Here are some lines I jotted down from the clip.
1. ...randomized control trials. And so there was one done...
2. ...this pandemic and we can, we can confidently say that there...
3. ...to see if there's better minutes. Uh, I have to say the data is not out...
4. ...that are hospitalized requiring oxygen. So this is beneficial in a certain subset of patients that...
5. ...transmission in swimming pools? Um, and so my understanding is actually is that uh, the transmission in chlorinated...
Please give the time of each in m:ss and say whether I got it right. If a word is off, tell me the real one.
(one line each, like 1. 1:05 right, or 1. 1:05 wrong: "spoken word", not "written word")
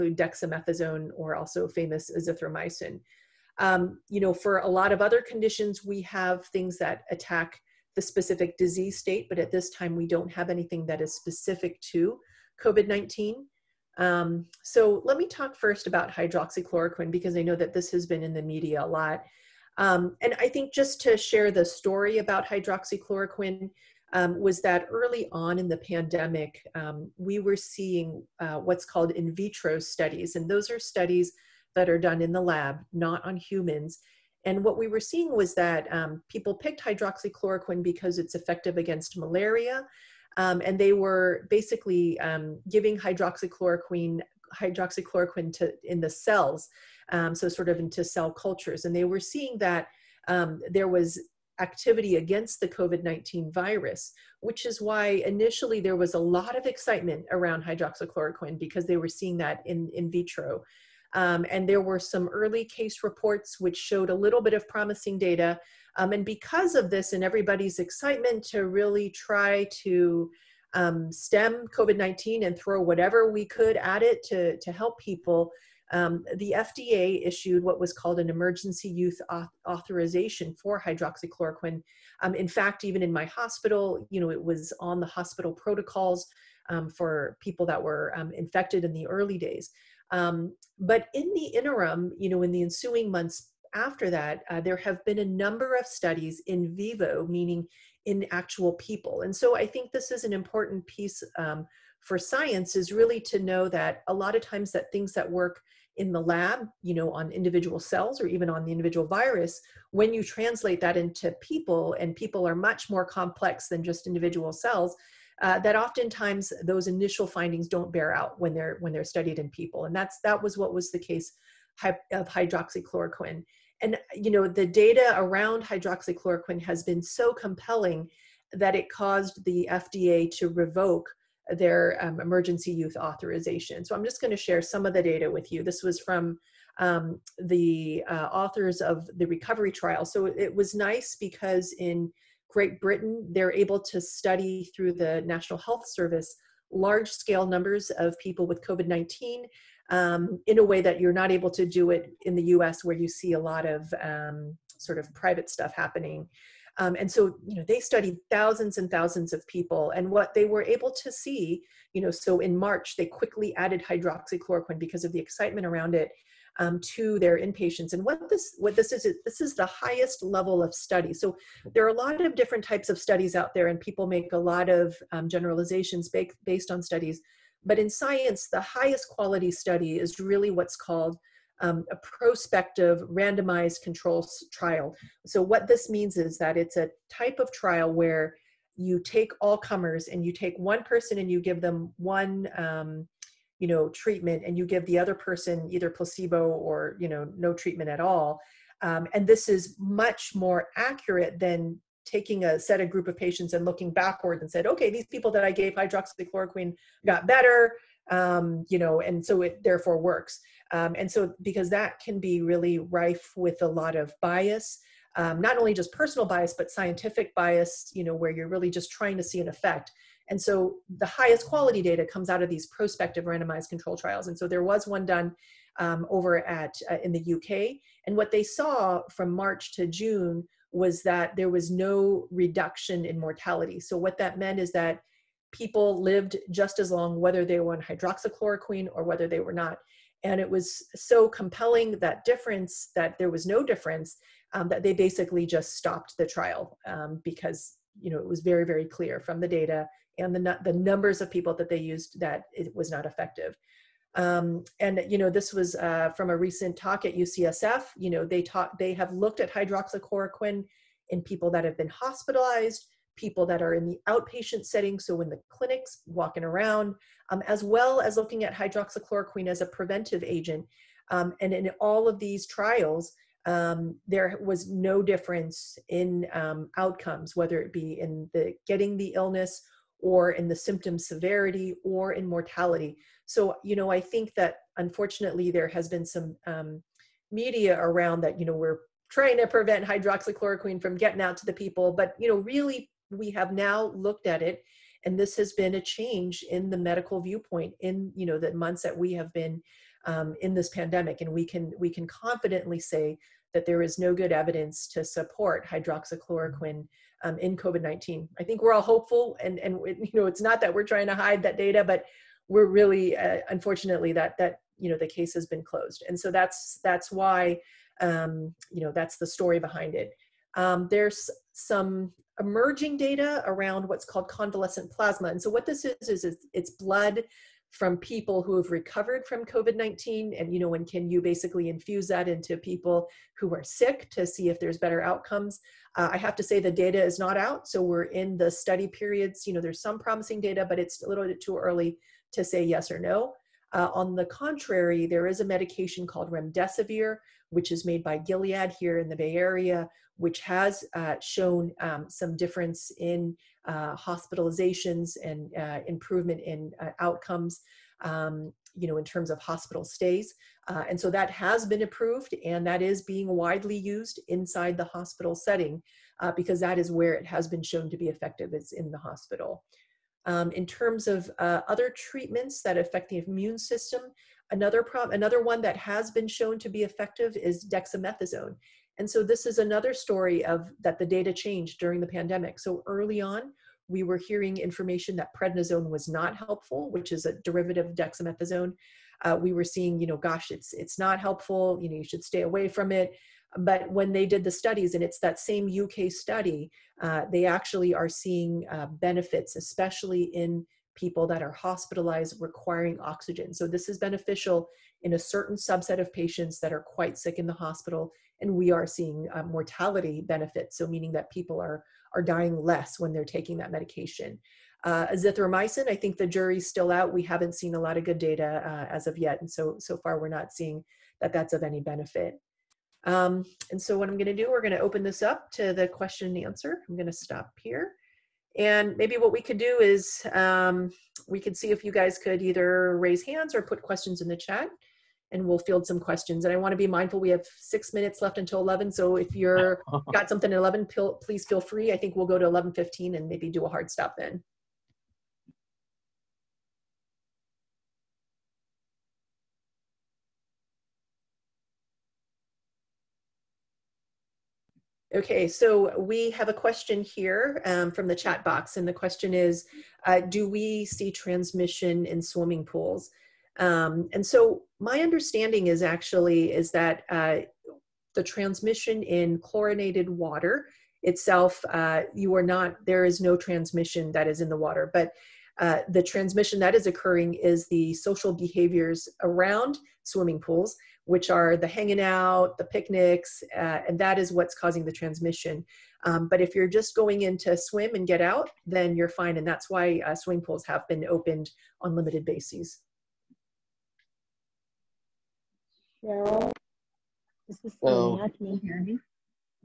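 1. 3:43 right
2. 5:00 right
3. 5:34 wrong: "outcomes", not "minutes"
4. 6:41 right
5. 7:41 right.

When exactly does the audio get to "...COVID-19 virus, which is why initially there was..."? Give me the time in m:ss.
0:52.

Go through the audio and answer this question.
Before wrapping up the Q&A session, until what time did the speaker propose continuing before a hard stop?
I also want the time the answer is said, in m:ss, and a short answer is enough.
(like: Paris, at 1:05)
11:15, at 7:22.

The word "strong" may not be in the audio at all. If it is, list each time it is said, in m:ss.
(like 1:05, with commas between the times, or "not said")
not said.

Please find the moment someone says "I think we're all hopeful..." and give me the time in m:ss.
5:08.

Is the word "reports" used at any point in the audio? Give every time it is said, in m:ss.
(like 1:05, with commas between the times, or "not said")
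1:03.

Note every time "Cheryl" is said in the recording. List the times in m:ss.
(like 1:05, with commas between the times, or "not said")
8:16.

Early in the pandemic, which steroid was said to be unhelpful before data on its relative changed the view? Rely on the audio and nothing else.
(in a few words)
prednisone.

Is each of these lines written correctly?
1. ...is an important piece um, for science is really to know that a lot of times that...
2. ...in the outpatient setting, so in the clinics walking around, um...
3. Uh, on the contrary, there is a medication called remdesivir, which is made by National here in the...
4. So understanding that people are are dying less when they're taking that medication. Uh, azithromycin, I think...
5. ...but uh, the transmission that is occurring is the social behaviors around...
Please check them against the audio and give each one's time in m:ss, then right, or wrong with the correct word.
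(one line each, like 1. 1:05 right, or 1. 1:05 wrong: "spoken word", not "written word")
1. 1:40 right
2. 4:23 right
3. 5:43 wrong: "Gilead", not "National"
4. 6:50 wrong: "meaning", not "understanding"
5. 7:54 right.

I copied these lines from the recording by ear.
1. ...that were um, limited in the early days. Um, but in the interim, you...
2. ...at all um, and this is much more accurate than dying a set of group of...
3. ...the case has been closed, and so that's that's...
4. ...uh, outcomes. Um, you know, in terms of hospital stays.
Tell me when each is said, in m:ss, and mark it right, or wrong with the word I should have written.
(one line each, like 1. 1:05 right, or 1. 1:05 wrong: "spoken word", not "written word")
1. 1:27 wrong: "infected", not "limited"
2. 3:17 wrong: "taking", not "dying"
3. 5:14 right
4. 5:56 right.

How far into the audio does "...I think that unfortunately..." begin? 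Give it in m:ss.
4:43.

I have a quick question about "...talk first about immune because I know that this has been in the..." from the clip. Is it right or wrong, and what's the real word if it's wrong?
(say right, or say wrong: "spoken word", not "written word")
wrong: "hydroxychloroquine", not "immune".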